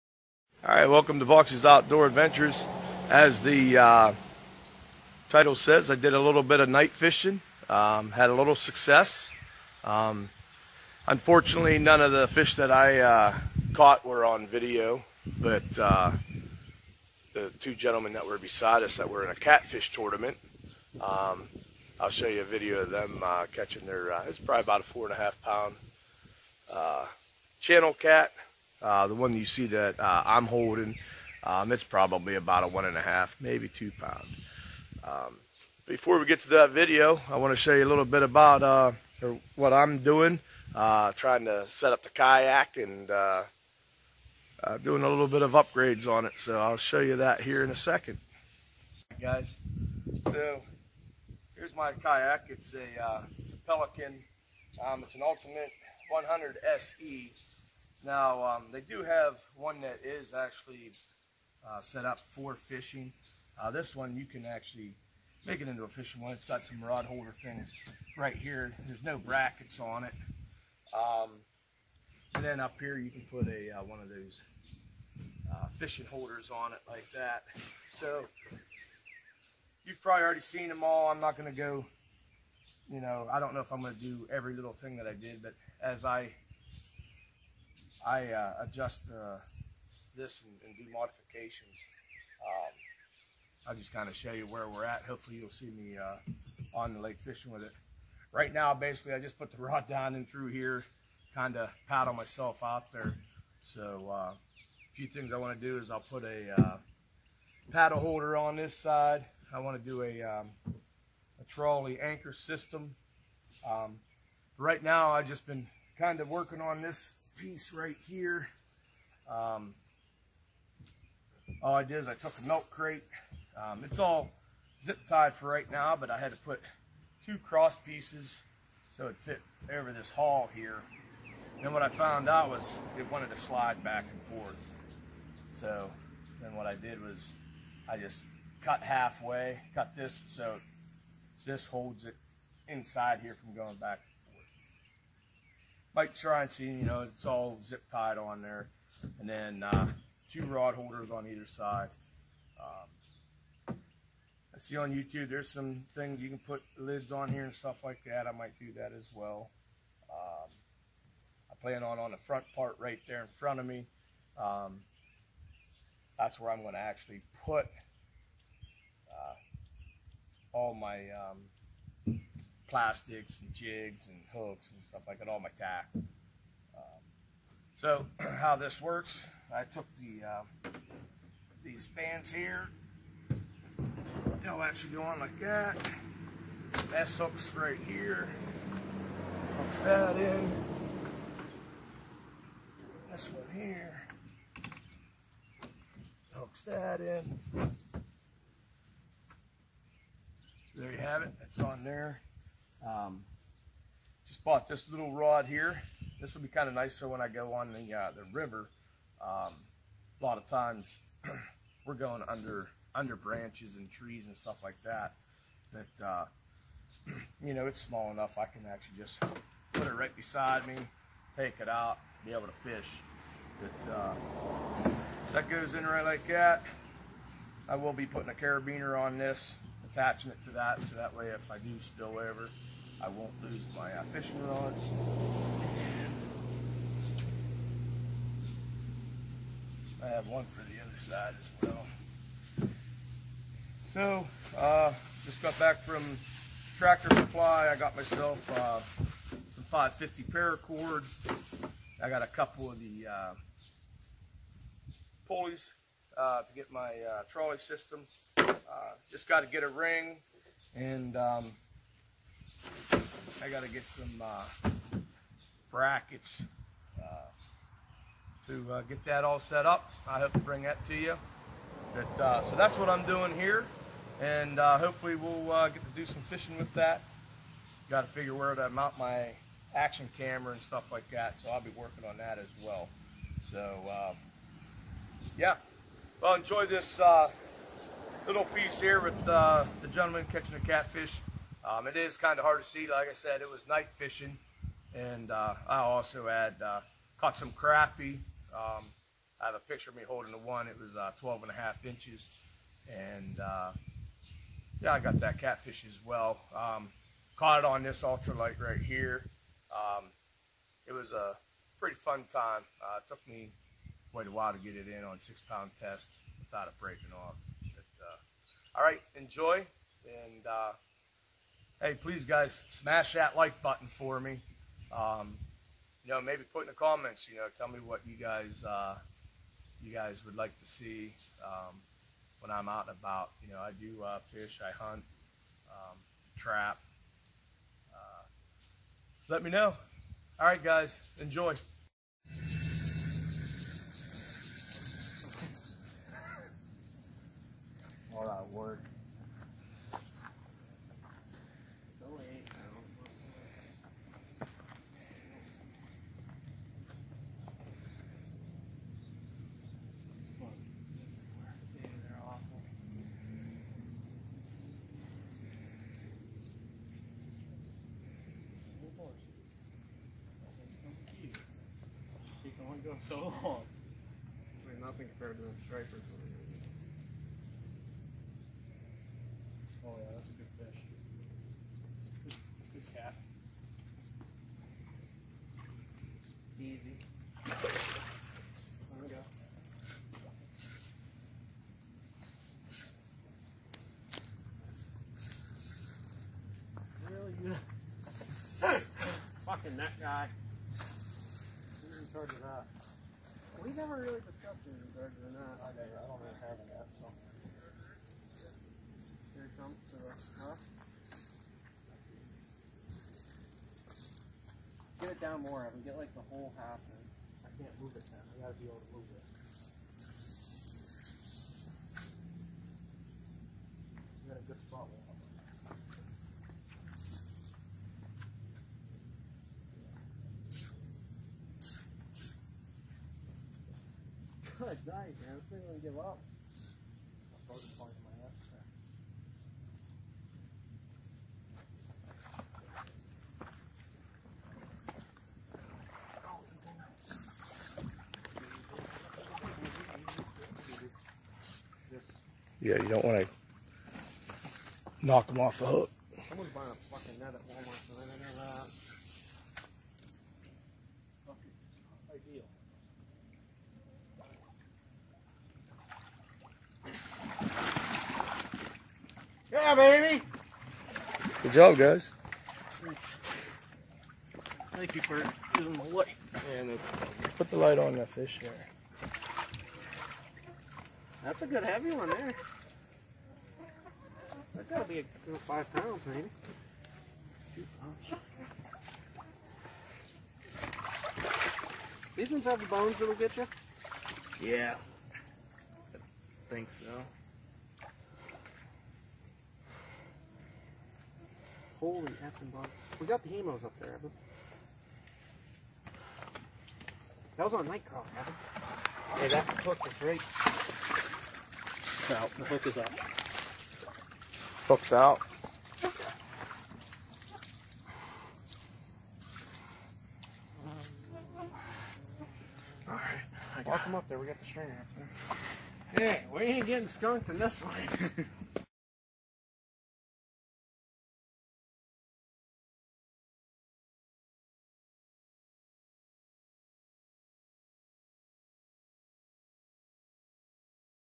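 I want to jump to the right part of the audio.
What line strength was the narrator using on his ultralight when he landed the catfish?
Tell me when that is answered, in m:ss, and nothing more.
5:15.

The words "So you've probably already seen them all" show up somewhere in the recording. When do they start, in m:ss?
1:17.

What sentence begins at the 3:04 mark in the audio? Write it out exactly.
They'll actually go on like that.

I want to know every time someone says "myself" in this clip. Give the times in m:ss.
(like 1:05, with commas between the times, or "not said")
1:42, 4:07.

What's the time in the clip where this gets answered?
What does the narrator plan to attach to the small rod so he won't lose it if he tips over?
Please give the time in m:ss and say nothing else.
3:48.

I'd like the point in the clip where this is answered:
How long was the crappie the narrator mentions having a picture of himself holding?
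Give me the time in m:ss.
5:01.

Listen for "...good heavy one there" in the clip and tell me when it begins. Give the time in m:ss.
8:01.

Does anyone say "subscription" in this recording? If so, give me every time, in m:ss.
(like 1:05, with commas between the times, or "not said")
not said.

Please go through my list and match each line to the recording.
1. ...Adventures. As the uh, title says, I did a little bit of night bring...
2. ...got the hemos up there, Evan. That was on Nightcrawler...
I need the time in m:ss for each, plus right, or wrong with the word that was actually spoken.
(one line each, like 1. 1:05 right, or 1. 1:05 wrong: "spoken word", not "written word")
1. 0:02 wrong: "fishing", not "bring"
2. 8:23 right.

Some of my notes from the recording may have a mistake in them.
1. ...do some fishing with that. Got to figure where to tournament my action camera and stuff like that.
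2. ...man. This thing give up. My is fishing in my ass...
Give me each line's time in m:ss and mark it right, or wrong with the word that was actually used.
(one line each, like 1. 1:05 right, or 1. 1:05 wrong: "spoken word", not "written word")
1. 4:35 wrong: "mount", not "tournament"
2. 7:14 wrong: "falling", not "fishing".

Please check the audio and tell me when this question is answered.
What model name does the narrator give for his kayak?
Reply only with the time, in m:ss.
0:55.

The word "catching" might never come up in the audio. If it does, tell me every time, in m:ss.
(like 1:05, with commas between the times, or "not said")
0:23, 4:50.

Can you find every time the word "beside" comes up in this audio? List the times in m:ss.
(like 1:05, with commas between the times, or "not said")
0:18, 3:40.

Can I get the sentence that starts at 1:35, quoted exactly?
Hopefully you'll see me uh, on the lake fishing with it.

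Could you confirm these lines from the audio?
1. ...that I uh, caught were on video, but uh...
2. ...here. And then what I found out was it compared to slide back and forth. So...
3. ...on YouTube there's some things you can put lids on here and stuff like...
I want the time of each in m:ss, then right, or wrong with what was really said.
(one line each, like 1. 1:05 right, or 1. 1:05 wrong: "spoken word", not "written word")
1. 0:12 right
2. 2:10 wrong: "wanted", not "compared"
3. 2:34 right.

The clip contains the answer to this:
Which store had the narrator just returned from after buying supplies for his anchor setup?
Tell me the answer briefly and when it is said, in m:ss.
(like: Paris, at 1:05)
Tractor Supply, at 4:06.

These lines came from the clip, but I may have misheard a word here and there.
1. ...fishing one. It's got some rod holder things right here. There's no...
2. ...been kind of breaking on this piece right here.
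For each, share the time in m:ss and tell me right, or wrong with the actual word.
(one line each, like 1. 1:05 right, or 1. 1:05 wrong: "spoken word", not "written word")
1. 1:05 right
2. 1:55 wrong: "working", not "breaking".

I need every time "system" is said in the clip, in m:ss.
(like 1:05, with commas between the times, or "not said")
1:52, 4:17.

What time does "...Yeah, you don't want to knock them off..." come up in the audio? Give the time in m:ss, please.
7:32.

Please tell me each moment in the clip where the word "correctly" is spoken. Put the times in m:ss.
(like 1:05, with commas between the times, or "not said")
not said.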